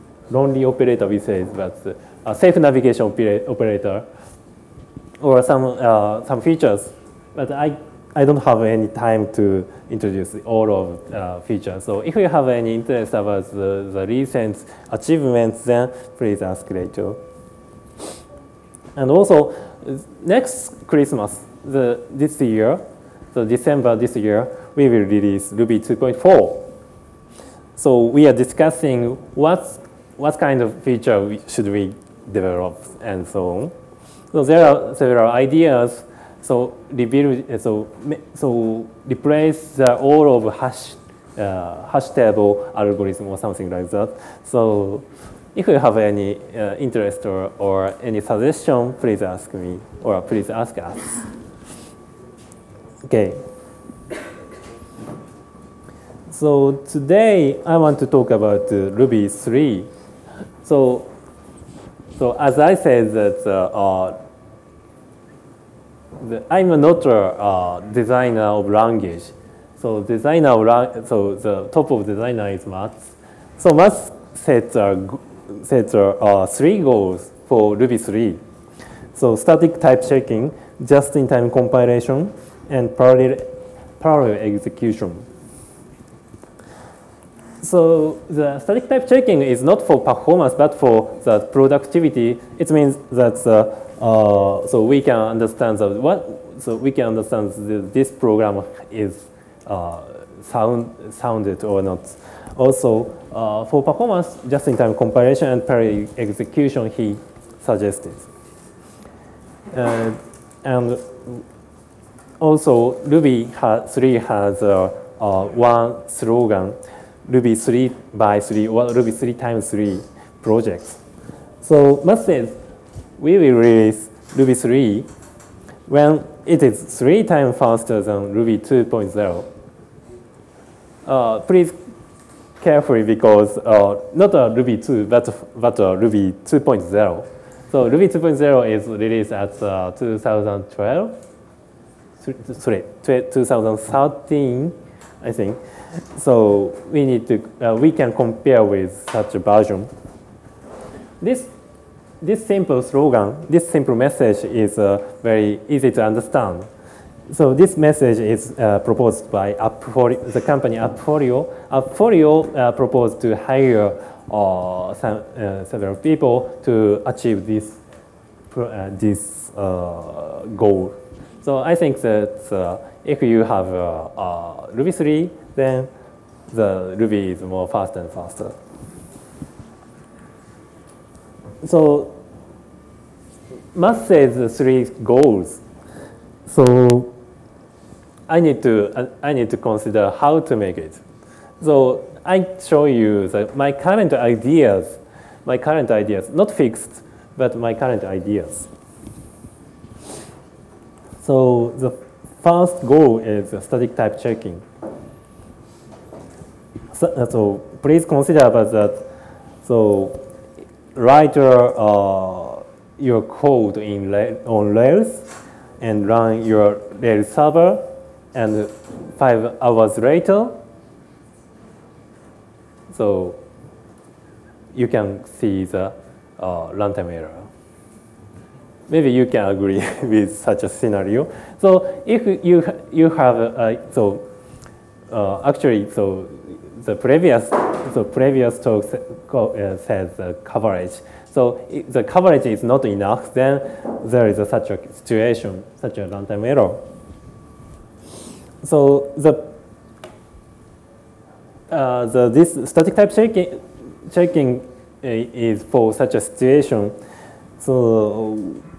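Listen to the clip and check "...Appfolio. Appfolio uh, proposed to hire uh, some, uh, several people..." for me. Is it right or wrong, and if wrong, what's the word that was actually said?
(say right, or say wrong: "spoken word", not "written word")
right.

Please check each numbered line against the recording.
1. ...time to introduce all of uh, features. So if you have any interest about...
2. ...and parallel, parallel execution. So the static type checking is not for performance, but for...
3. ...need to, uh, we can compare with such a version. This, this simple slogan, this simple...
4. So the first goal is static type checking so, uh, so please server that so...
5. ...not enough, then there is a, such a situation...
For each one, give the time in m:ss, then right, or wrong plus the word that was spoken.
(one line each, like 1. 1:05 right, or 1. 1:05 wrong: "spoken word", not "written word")
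1. 0:08 right
2. 1:22 right
3. 2:27 right
4. 3:21 wrong: "consider", not "server"
5. 4:02 right.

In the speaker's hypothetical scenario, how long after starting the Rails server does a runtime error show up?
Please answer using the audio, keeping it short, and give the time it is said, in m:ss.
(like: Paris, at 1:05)
5 hours, at 3:39.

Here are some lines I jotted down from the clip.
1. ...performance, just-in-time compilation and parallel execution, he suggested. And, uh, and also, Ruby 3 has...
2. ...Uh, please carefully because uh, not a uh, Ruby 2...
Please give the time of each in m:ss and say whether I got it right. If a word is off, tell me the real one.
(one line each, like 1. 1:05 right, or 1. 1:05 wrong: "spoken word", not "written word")
1. 1:43 right
2. 2:11 right.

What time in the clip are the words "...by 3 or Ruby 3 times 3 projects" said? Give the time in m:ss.
1:58.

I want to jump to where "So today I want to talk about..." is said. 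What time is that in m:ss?
0:56.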